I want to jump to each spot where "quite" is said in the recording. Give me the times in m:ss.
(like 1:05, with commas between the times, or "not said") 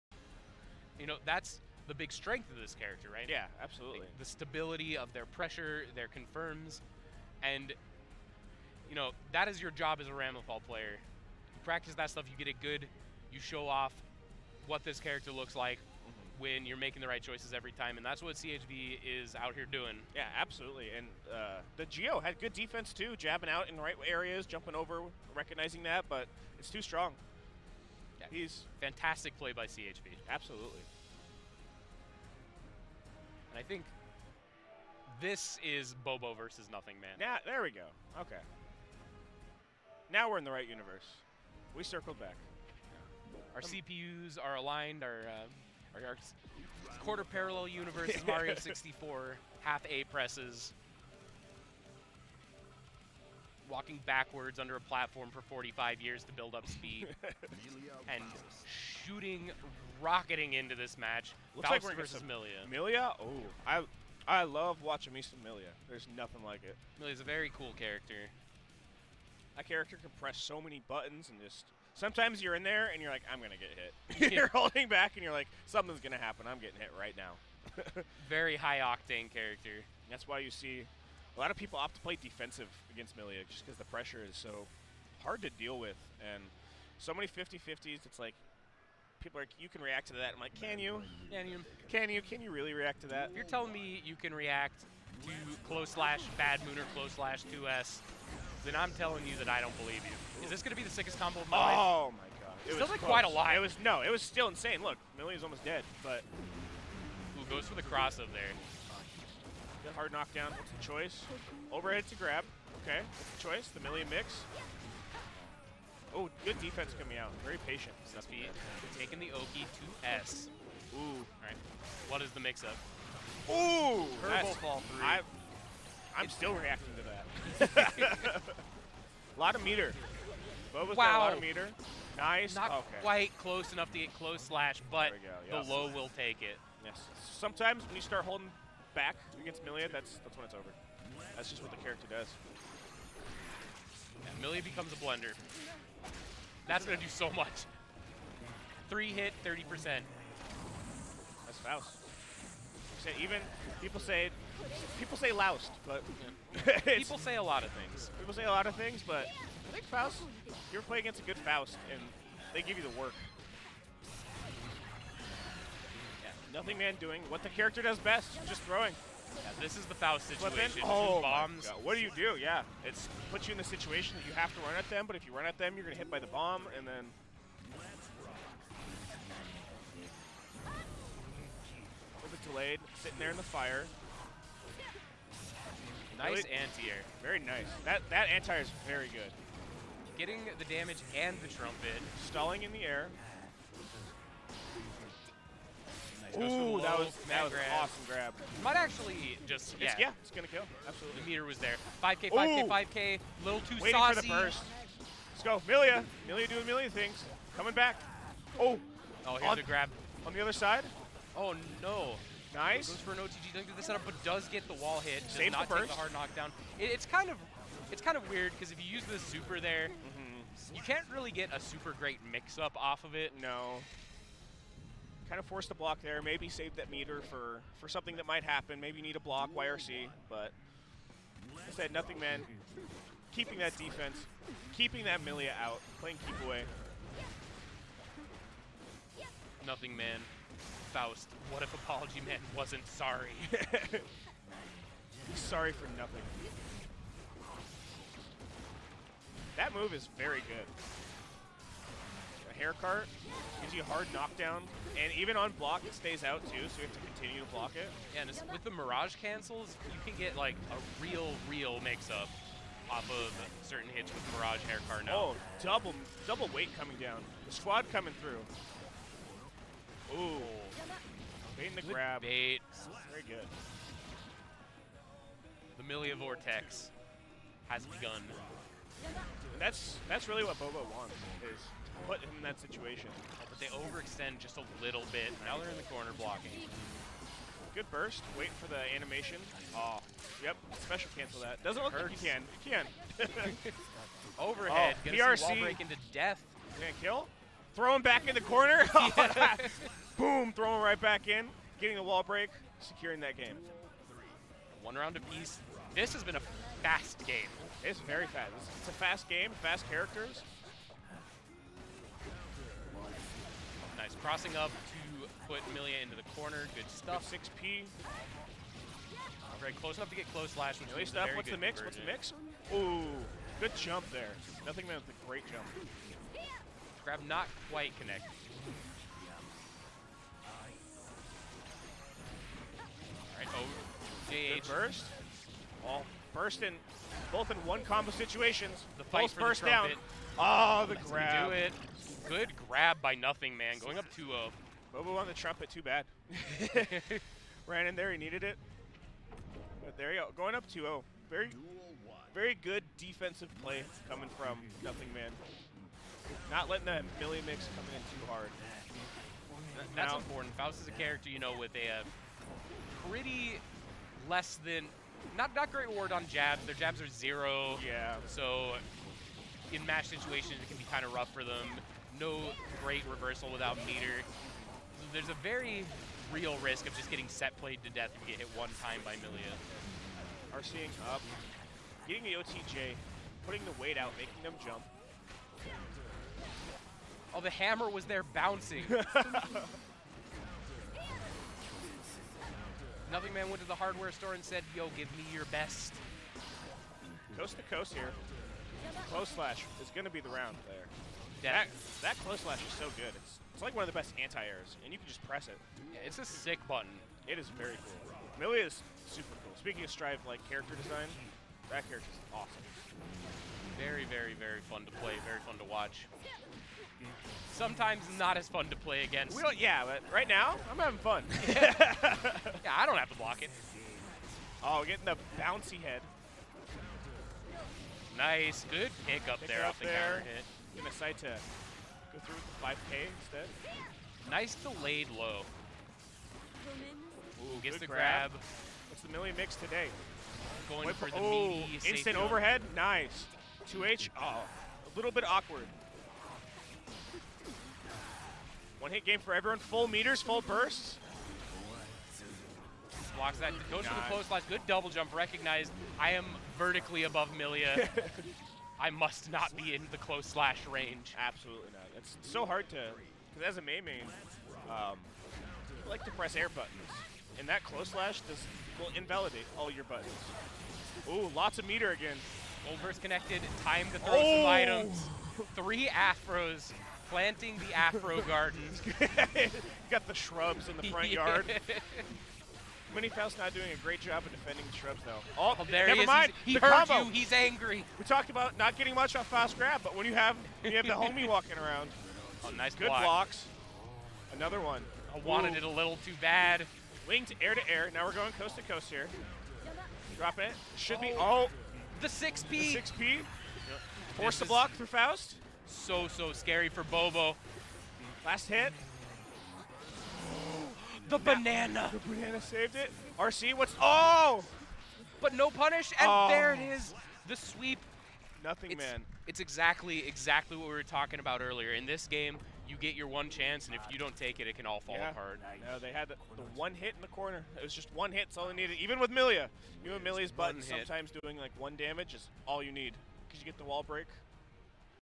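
1:43, 2:13, 5:27.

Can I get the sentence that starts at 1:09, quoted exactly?
That character can press so many buttons and just.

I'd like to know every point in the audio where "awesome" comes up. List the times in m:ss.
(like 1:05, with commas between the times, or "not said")
3:17, 6:52.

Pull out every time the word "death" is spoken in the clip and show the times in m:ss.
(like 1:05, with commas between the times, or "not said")
4:56, 6:17.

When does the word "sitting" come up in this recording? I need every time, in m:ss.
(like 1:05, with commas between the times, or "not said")
3:03.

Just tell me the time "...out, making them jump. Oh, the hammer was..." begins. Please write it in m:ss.
6:23.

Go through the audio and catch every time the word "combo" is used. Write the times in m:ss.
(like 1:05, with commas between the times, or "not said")
1:41, 5:37, 8:06.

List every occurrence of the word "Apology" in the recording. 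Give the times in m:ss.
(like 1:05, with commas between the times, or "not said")
4:01.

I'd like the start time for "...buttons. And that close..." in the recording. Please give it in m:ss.
7:46.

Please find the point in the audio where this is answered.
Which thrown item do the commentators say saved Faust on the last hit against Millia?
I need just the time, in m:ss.
8:31.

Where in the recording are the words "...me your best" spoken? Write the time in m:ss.
6:35.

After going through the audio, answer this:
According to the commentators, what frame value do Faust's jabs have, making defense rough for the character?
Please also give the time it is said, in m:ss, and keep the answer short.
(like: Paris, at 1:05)
Zero, at 6:06.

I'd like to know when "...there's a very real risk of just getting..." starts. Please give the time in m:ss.
6:15.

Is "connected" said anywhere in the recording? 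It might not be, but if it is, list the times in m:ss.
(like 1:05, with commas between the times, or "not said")
5:27, 7:53.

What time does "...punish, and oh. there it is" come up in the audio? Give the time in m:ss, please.
8:35.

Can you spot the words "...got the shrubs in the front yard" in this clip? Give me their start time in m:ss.
7:59.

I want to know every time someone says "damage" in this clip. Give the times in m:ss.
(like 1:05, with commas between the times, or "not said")
3:10, 8:51.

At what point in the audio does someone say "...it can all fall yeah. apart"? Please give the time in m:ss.
8:44.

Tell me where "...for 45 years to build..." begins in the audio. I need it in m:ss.
0:55.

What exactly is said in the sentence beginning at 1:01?
Looks Faust like we're versus Millia.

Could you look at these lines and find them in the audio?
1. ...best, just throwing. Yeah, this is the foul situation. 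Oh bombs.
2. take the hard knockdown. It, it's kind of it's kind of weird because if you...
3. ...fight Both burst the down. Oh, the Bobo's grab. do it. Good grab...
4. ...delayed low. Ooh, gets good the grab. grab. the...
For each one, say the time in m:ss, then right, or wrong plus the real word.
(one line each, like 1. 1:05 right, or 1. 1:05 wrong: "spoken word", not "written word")
1. 2:47 right
2. 3:35 right
3. 5:39 wrong: "Let", not "Bobo"
4. 7:14 right.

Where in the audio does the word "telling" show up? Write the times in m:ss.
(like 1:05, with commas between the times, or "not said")
1:33, 1:38.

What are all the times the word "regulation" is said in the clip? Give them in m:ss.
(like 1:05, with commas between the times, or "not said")
not said.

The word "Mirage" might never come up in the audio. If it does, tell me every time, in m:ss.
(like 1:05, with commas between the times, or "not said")
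4:18, 4:24.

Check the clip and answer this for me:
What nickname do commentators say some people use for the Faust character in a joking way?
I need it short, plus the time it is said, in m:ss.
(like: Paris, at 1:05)
Loust, at 2:34.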